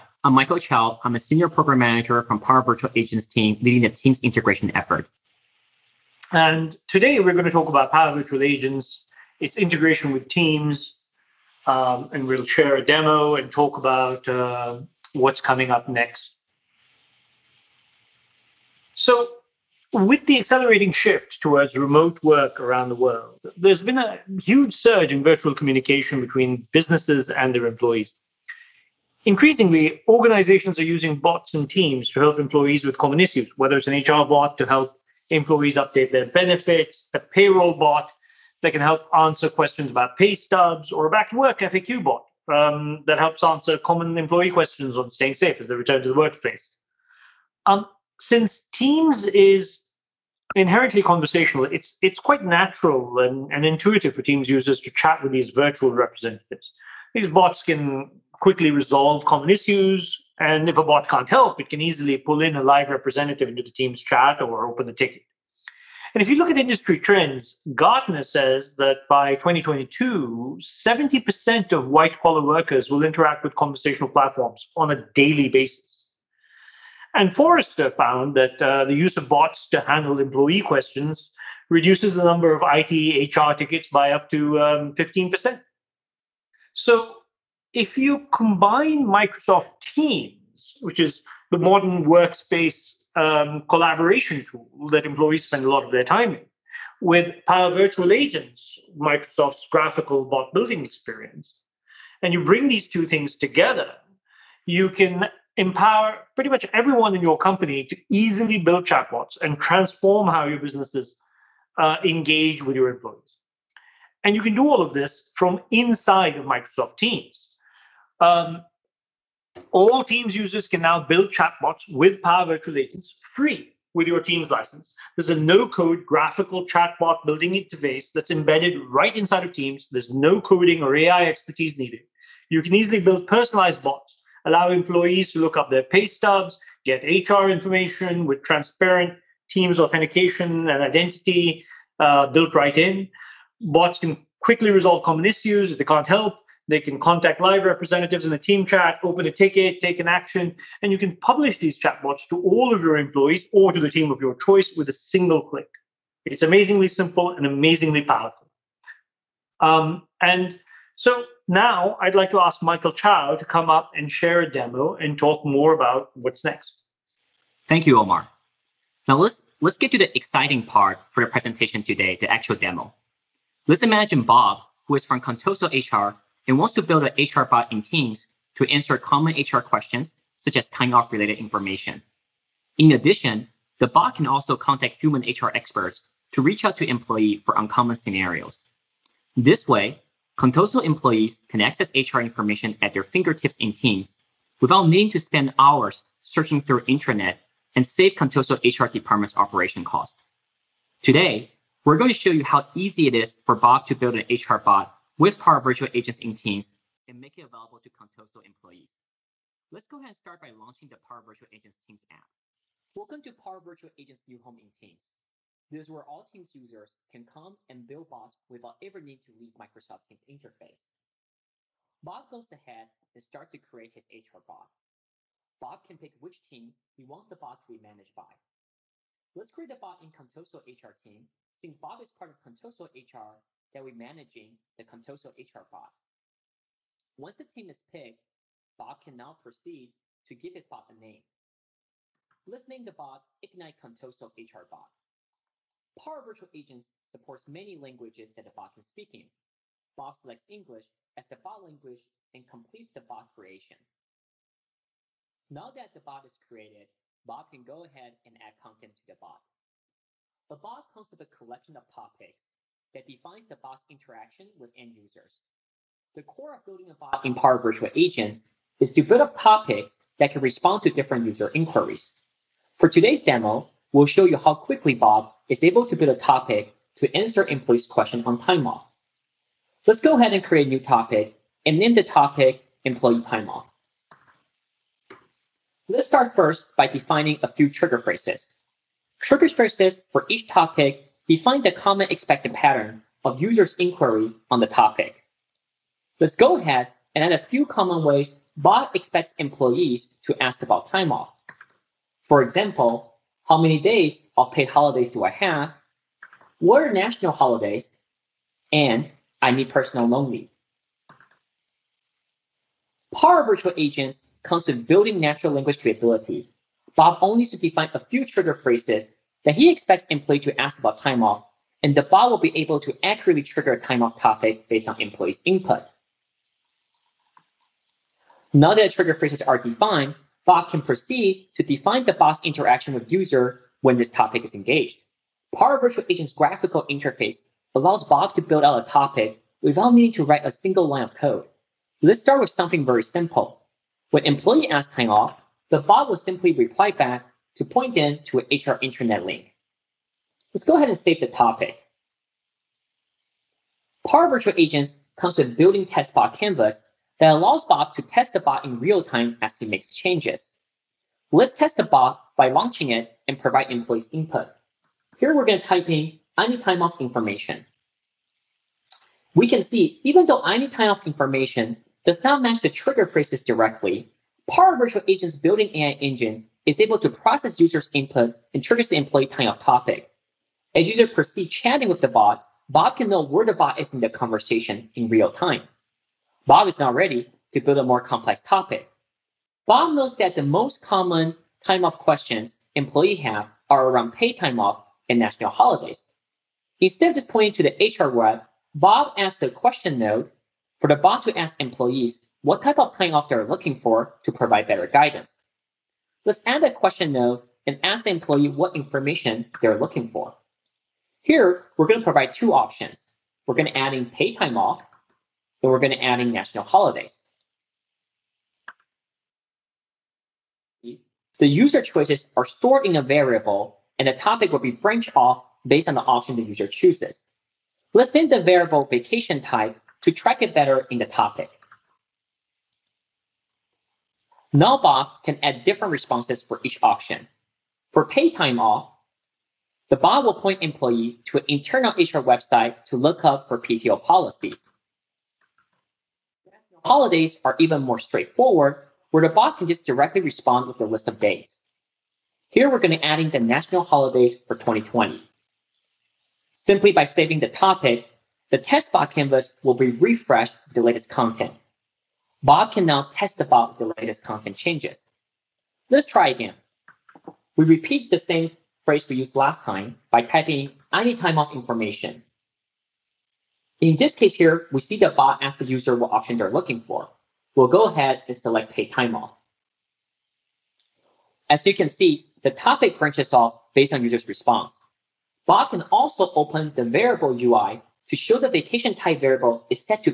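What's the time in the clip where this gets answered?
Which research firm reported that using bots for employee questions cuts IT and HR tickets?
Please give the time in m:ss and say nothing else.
1:17.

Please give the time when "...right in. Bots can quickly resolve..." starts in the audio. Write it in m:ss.
2:22.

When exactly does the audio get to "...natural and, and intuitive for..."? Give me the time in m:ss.
0:52.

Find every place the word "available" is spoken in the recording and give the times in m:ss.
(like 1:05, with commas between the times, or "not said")
3:27.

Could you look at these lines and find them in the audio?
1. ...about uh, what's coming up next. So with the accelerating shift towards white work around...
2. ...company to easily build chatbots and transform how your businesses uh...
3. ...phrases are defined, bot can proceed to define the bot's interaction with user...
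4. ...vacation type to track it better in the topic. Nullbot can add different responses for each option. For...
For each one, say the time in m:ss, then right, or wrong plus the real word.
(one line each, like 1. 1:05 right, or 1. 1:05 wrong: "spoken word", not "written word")
1. 0:13 wrong: "remote", not "white"
2. 1:47 right
3. 5:29 right
4. 7:08 right.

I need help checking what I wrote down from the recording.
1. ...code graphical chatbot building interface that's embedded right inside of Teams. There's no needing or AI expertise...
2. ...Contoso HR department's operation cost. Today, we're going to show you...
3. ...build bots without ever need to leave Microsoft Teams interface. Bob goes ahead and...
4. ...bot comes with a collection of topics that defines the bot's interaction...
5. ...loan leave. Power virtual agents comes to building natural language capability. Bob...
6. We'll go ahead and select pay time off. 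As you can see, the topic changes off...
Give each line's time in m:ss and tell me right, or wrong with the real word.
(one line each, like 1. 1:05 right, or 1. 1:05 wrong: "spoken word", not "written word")
1. 2:05 wrong: "coding", not "needing"
2. 3:18 right
3. 3:37 right
4. 4:20 right
5. 5:10 right
6. 7:57 wrong: "branches", not "changes".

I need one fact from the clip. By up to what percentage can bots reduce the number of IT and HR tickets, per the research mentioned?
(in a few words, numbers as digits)
15%.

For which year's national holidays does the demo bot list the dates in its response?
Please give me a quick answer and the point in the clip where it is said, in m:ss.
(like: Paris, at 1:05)
2020, at 7:34.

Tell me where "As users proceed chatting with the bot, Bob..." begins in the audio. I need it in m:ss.
6:20.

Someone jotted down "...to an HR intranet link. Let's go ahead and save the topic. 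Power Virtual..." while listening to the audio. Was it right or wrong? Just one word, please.
right.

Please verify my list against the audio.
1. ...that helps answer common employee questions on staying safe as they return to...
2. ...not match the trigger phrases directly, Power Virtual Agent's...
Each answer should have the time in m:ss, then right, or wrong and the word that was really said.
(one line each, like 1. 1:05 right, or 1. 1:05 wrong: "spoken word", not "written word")
1. 0:43 right
2. 6:12 right.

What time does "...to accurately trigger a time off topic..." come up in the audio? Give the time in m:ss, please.
5:22.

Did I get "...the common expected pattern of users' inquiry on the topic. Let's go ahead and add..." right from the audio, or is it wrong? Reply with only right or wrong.
right.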